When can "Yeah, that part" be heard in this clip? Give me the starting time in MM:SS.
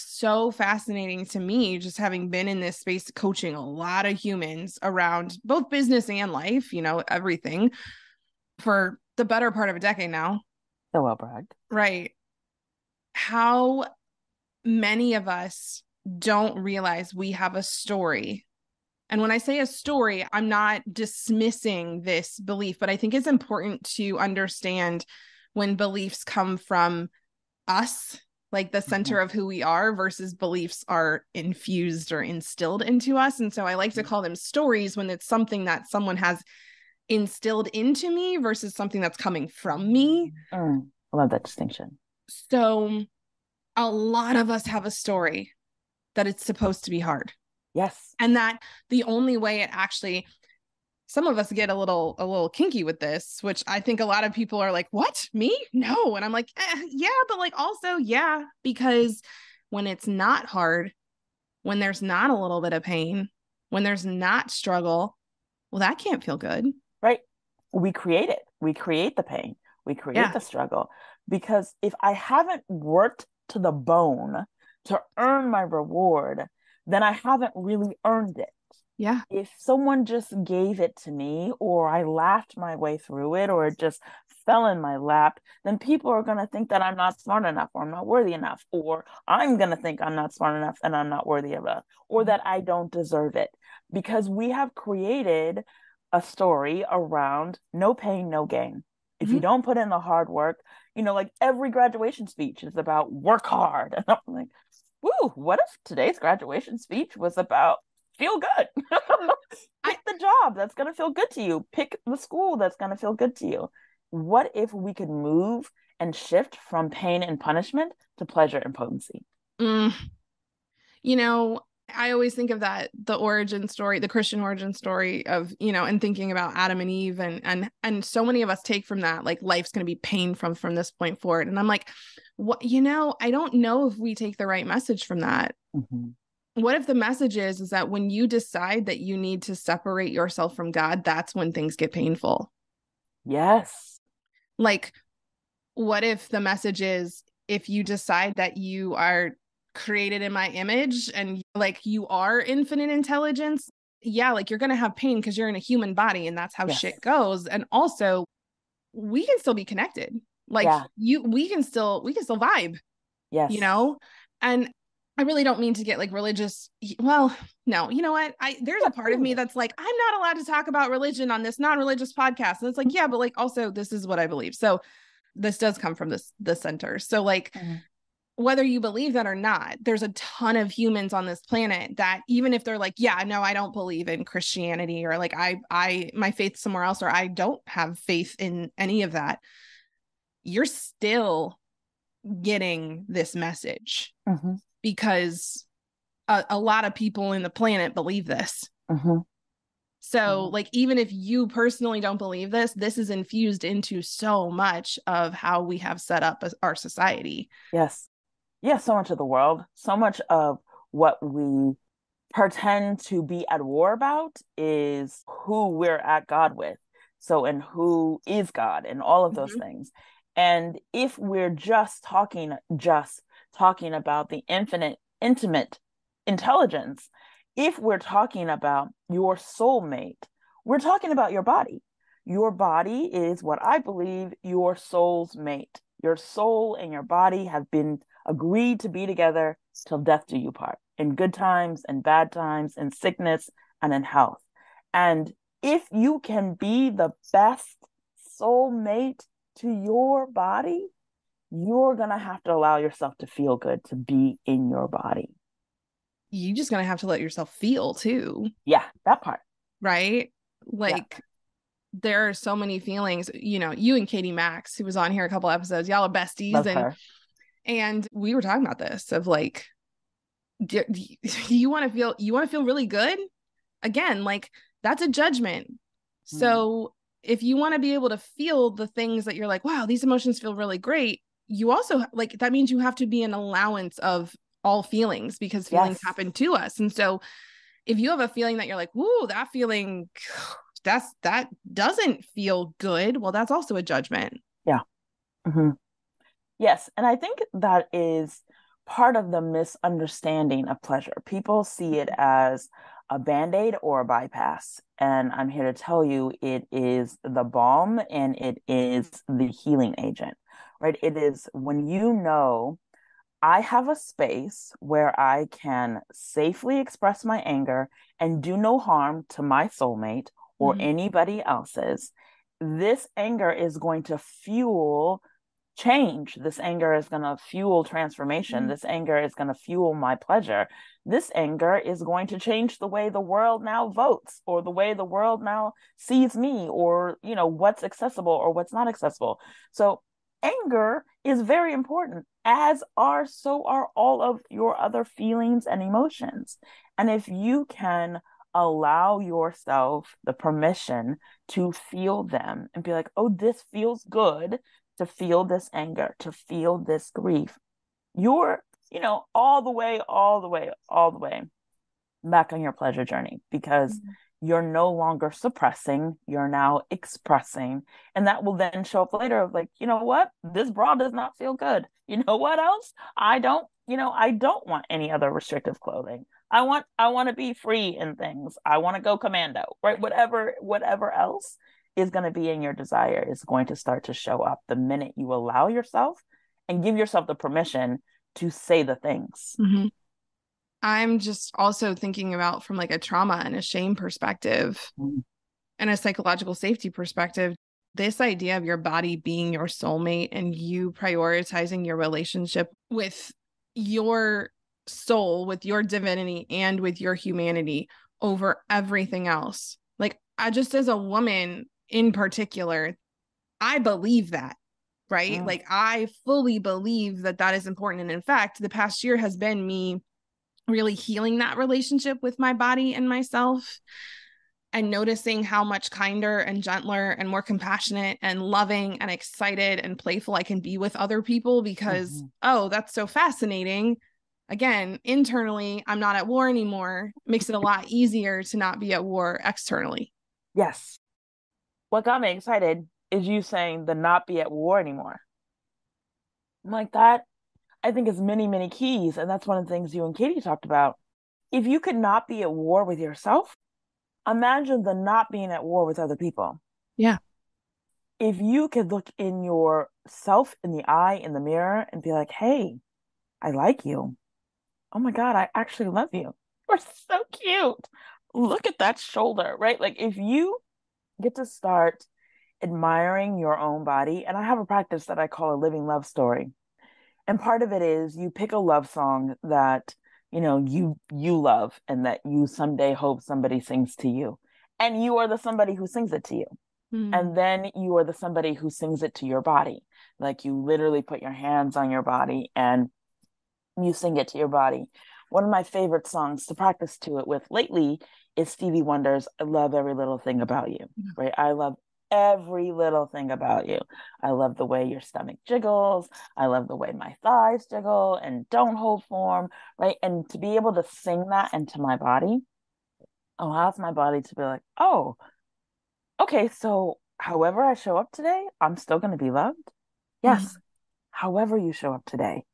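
04:18.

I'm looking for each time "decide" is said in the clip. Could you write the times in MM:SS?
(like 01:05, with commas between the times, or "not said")
02:18, 02:27.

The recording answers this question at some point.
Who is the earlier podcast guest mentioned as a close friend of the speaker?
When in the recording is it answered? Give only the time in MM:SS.
04:24.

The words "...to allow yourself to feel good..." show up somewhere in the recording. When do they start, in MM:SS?
04:12.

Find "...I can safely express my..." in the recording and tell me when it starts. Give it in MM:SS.
05:15.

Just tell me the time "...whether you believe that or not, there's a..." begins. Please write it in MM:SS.
02:58.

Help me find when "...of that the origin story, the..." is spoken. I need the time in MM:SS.
02:02.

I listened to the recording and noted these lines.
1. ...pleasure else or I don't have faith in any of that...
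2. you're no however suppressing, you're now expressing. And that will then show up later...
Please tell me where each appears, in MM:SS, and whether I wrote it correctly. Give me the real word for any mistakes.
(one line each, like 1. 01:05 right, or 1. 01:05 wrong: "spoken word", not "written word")
1. 03:06 wrong: "somewhere", not "pleasure"
2. 06:04 wrong: "longer", not "however".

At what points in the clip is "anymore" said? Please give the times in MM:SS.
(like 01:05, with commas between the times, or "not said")
07:16, 07:24.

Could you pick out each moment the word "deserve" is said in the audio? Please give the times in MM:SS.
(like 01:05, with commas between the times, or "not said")
01:32.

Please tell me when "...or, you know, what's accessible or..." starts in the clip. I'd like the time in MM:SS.
05:36.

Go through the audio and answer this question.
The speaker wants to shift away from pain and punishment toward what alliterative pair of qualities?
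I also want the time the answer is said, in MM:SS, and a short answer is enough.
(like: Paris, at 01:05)
Pleasure and potency, at 01:58.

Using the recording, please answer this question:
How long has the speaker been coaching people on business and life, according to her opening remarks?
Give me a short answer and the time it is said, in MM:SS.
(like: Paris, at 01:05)
A decade, at 00:09.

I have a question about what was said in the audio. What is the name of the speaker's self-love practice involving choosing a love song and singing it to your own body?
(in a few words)
A living love story.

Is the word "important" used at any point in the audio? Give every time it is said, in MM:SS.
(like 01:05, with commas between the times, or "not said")
00:23, 05:41, 06:57.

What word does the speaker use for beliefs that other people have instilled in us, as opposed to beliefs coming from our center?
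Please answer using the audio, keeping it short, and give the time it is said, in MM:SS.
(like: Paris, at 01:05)
Stories, at 00:34.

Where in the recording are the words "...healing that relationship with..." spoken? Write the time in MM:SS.
07:00.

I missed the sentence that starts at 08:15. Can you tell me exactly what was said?
One of my favorite songs to practice to it with lately is Stevie Wonder's I Love Every Little Thing About You, mm-hmm.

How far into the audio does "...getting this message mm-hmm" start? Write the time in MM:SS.
03:12.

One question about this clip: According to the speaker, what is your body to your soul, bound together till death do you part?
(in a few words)
Your soul's mate.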